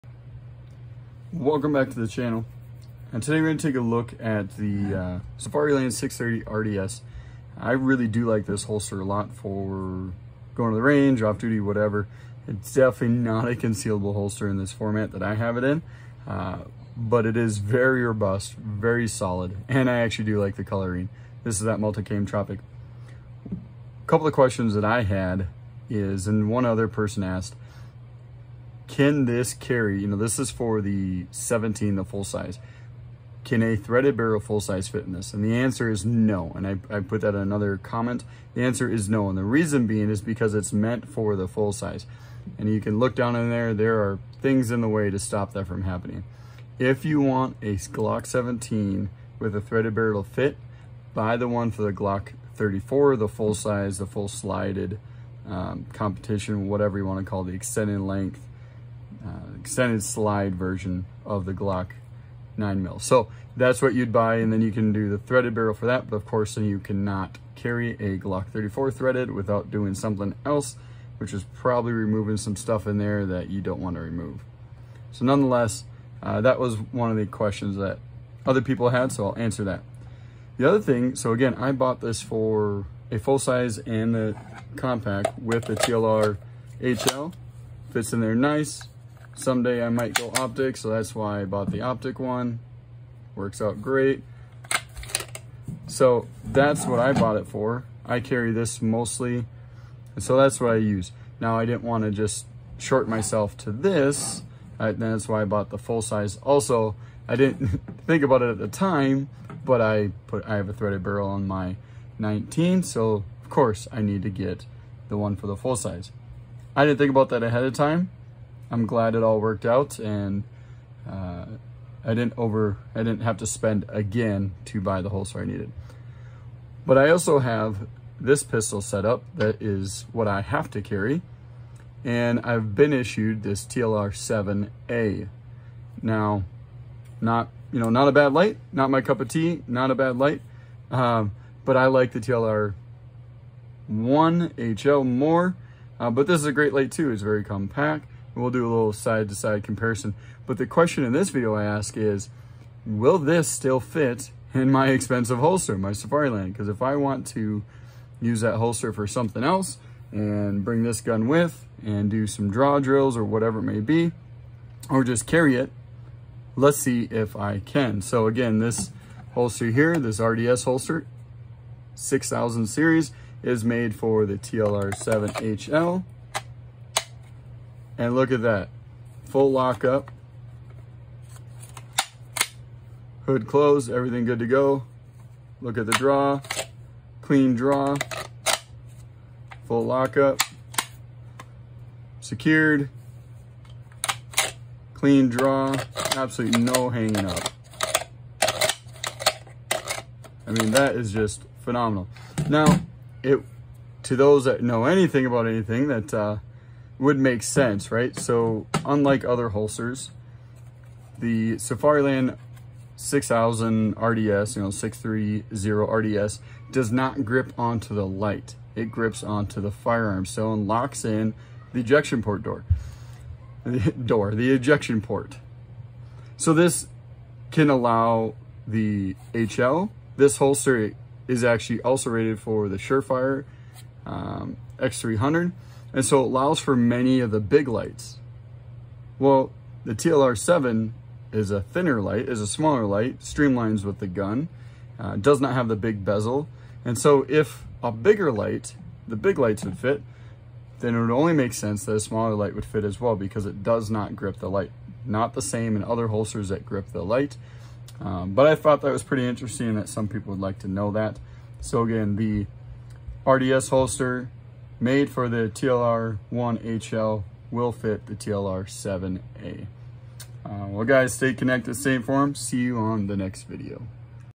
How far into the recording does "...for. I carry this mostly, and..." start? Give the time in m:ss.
1:37.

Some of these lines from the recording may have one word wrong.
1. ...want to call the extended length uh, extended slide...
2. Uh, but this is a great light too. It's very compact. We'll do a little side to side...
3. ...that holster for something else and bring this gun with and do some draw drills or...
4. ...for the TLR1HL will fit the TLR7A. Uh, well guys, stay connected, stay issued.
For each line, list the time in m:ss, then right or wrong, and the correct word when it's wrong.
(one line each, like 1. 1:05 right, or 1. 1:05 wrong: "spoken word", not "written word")
1. 0:57 right
2. 2:25 right
3. 2:38 right
4. 4:25 wrong: "informed", not "issued".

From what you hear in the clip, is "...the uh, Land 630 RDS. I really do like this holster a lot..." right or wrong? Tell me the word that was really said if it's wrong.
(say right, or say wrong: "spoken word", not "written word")
right.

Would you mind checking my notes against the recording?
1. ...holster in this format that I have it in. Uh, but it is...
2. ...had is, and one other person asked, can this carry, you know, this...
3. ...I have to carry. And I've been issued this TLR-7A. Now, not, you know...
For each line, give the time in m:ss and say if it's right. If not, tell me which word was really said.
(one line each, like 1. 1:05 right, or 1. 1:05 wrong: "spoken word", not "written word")
1. 0:14 right
2. 0:25 right
3. 2:10 right.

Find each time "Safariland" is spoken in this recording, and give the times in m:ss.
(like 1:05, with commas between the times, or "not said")
2:35, 3:31.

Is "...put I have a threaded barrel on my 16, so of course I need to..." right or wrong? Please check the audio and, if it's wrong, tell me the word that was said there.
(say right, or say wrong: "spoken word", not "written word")
wrong: "19", not "16".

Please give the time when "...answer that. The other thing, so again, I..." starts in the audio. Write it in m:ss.
1:19.